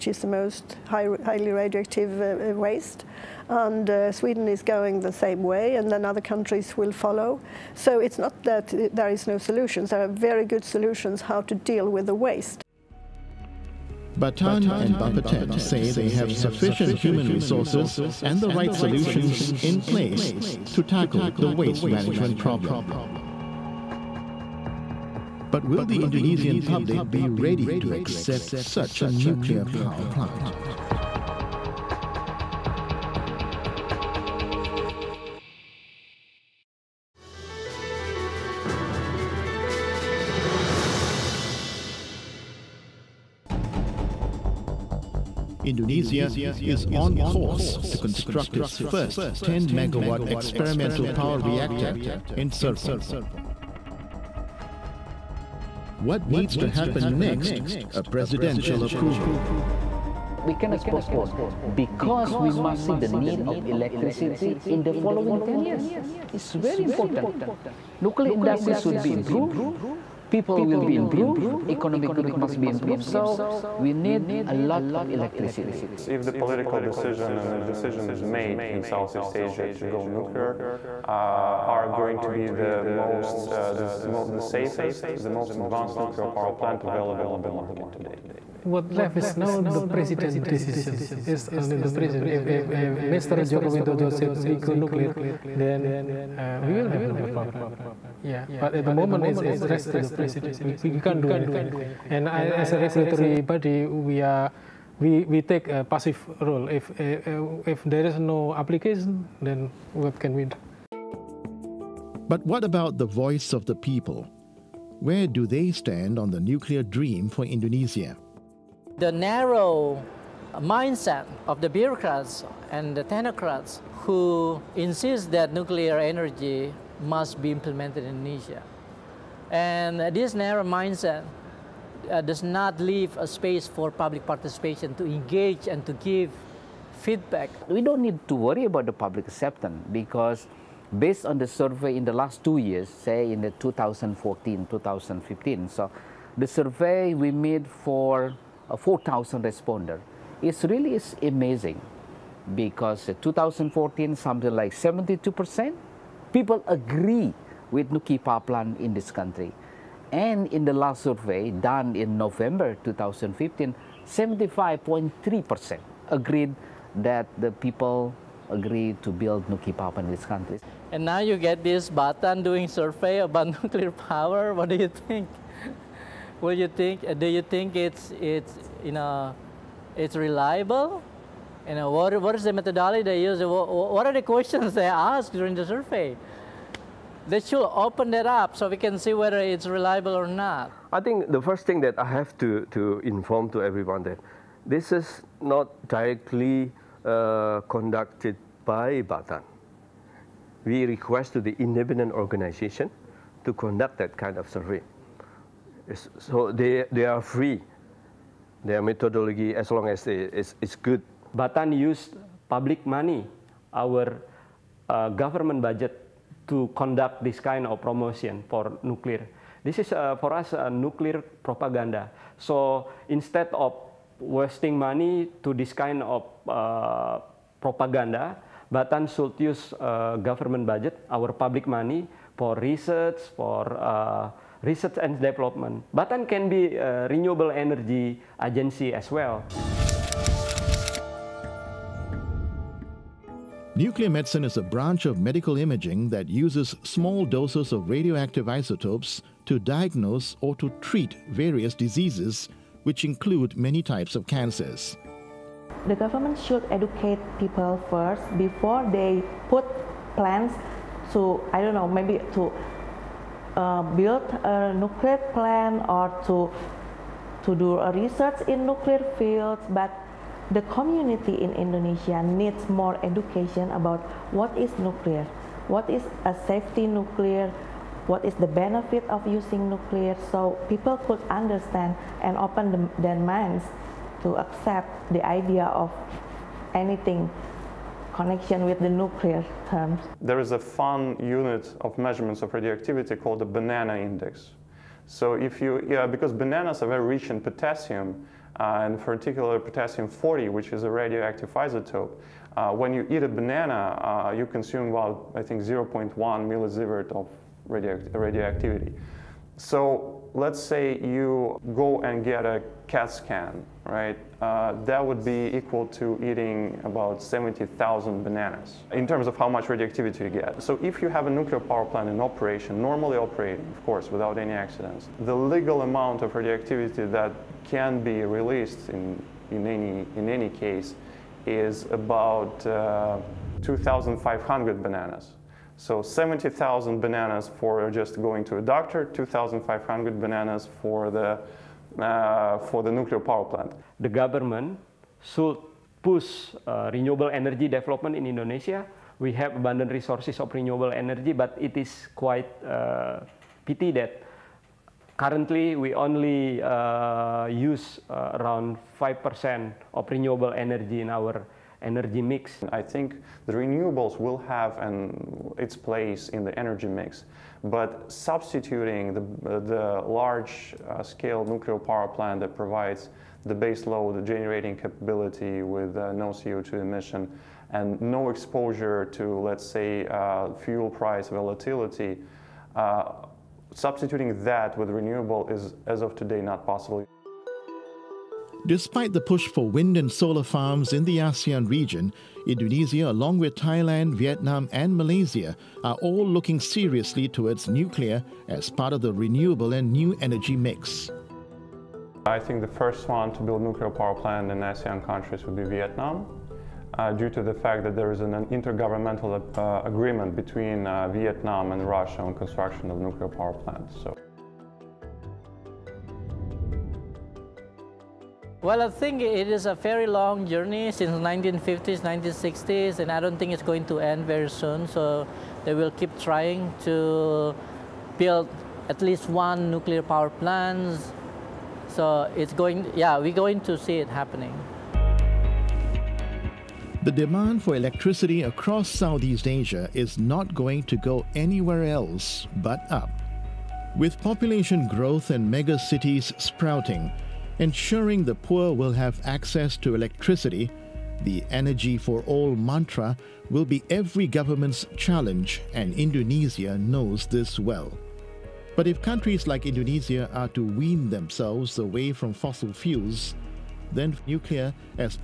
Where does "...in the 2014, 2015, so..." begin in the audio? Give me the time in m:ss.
2:23.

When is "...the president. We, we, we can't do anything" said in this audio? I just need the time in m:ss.
1:39.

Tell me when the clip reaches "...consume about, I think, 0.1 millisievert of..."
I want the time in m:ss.
5:04.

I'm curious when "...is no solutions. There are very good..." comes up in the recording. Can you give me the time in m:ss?
0:09.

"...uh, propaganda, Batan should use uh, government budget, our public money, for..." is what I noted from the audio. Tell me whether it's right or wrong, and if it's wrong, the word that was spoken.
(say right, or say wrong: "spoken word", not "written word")
right.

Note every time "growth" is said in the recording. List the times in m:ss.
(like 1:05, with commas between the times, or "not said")
1:12, 7:24.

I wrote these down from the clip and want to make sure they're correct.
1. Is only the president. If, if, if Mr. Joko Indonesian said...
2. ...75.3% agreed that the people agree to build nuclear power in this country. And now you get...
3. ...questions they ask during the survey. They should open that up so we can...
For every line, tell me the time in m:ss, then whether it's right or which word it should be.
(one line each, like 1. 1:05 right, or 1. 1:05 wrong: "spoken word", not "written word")
1. 1:31 wrong: "Widodo", not "Indonesian"
2. 2:44 right
3. 3:04 right.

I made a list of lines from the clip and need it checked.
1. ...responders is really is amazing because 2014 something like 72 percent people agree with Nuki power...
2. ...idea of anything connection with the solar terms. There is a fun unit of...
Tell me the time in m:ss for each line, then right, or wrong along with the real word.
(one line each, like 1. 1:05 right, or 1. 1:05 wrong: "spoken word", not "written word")
1. 2:29 right
2. 4:45 wrong: "nuclear", not "solar".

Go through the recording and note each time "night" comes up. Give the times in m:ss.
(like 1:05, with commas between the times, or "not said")
not said.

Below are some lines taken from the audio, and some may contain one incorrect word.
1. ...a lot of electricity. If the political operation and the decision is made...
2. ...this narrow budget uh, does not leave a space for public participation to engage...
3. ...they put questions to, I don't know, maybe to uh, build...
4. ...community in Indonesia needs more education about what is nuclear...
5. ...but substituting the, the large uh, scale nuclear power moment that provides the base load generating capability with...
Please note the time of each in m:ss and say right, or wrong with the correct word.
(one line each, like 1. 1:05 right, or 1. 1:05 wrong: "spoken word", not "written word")
1. 1:14 wrong: "decision", not "operation"
2. 2:10 wrong: "mindset", not "budget"
3. 4:18 wrong: "plans", not "questions"
4. 4:30 right
5. 6:07 wrong: "plant", not "moment".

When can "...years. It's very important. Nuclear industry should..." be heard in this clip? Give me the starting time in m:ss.
1:05.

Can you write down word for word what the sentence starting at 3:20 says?
We request to the independent organization to conduct that kind of survey.